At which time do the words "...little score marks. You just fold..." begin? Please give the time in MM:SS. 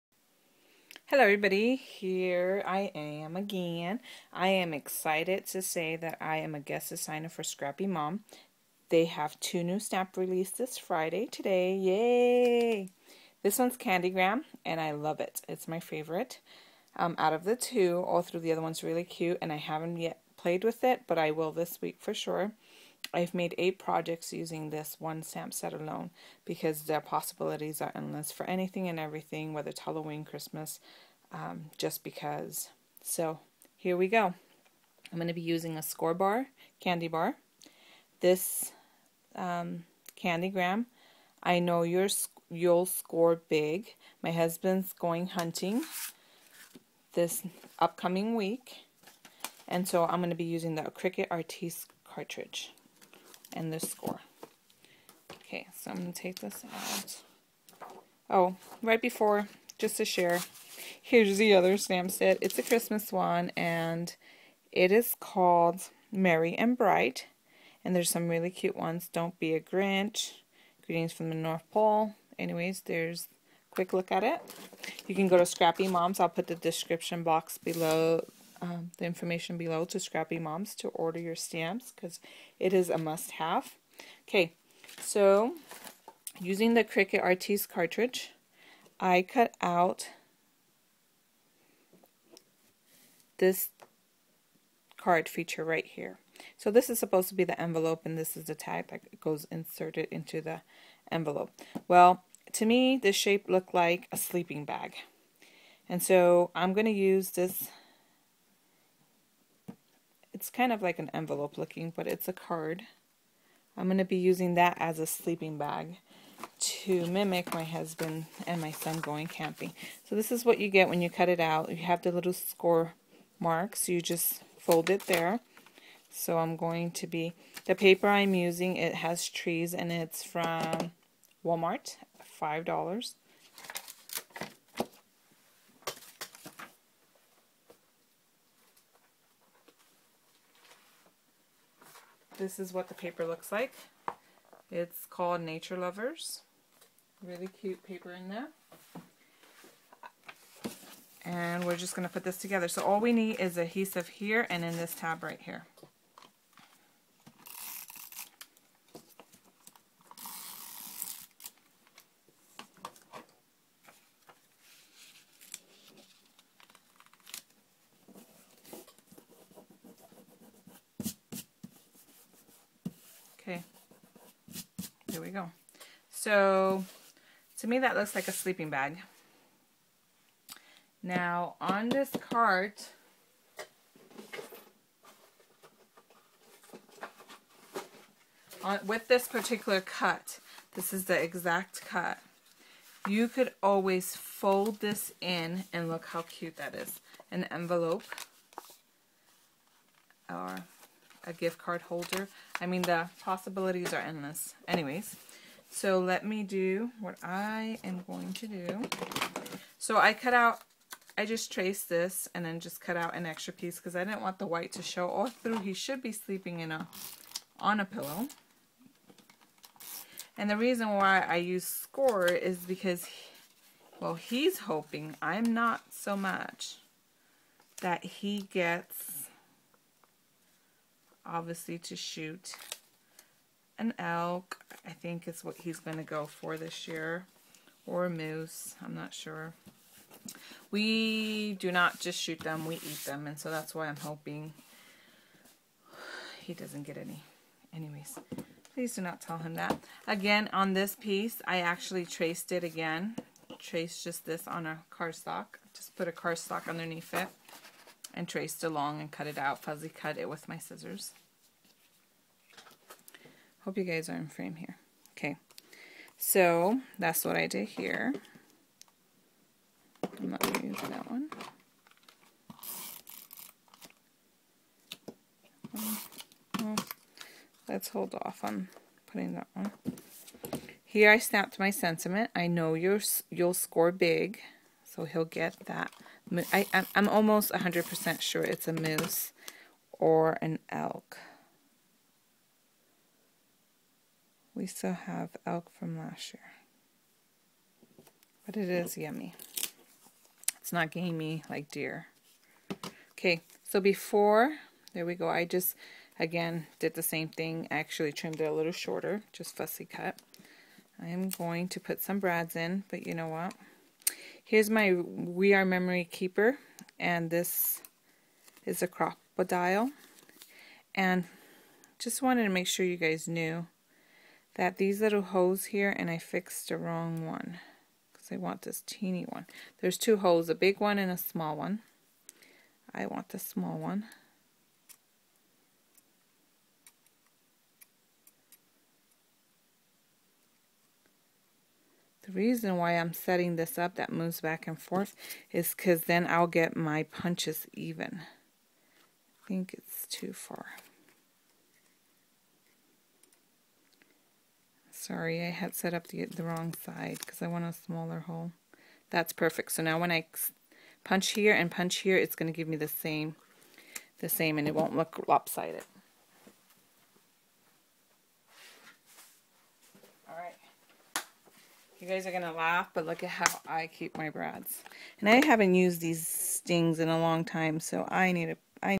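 02:02.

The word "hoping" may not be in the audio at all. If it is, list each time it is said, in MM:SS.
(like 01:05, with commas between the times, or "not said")
03:44, 04:03.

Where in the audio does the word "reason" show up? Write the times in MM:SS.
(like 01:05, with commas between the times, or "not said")
03:40, 05:42.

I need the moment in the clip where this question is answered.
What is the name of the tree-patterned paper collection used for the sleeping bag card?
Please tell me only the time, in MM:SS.
02:25.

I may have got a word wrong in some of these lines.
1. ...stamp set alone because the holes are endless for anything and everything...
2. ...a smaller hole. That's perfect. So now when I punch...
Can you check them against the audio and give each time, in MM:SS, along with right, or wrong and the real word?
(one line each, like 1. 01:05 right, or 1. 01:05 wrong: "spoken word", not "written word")
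1. 00:25 wrong: "possibilities", not "holes"
2. 05:57 right.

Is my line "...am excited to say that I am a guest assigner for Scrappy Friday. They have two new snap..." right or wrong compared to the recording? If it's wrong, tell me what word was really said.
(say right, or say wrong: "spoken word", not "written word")
wrong: "Mom", not "Friday".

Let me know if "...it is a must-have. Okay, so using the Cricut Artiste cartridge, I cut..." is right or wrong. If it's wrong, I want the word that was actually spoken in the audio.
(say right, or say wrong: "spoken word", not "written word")
right.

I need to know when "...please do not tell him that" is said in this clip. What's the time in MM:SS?
04:08.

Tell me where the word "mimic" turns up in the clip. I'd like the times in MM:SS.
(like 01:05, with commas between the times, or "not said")
01:57.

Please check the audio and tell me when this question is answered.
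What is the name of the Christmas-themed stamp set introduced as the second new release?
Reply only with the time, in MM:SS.
01:06.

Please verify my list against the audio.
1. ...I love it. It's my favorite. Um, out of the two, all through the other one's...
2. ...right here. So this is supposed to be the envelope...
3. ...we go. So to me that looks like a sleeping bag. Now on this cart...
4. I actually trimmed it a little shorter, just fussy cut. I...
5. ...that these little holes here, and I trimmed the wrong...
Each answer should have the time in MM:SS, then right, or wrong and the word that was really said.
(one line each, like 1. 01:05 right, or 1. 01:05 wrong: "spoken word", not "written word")
1. 00:14 right
2. 01:35 right
3. 02:55 right
4. 05:07 right
5. 05:24 wrong: "fixed", not "trimmed".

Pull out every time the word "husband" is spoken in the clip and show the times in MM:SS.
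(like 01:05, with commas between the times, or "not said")
00:44, 01:57.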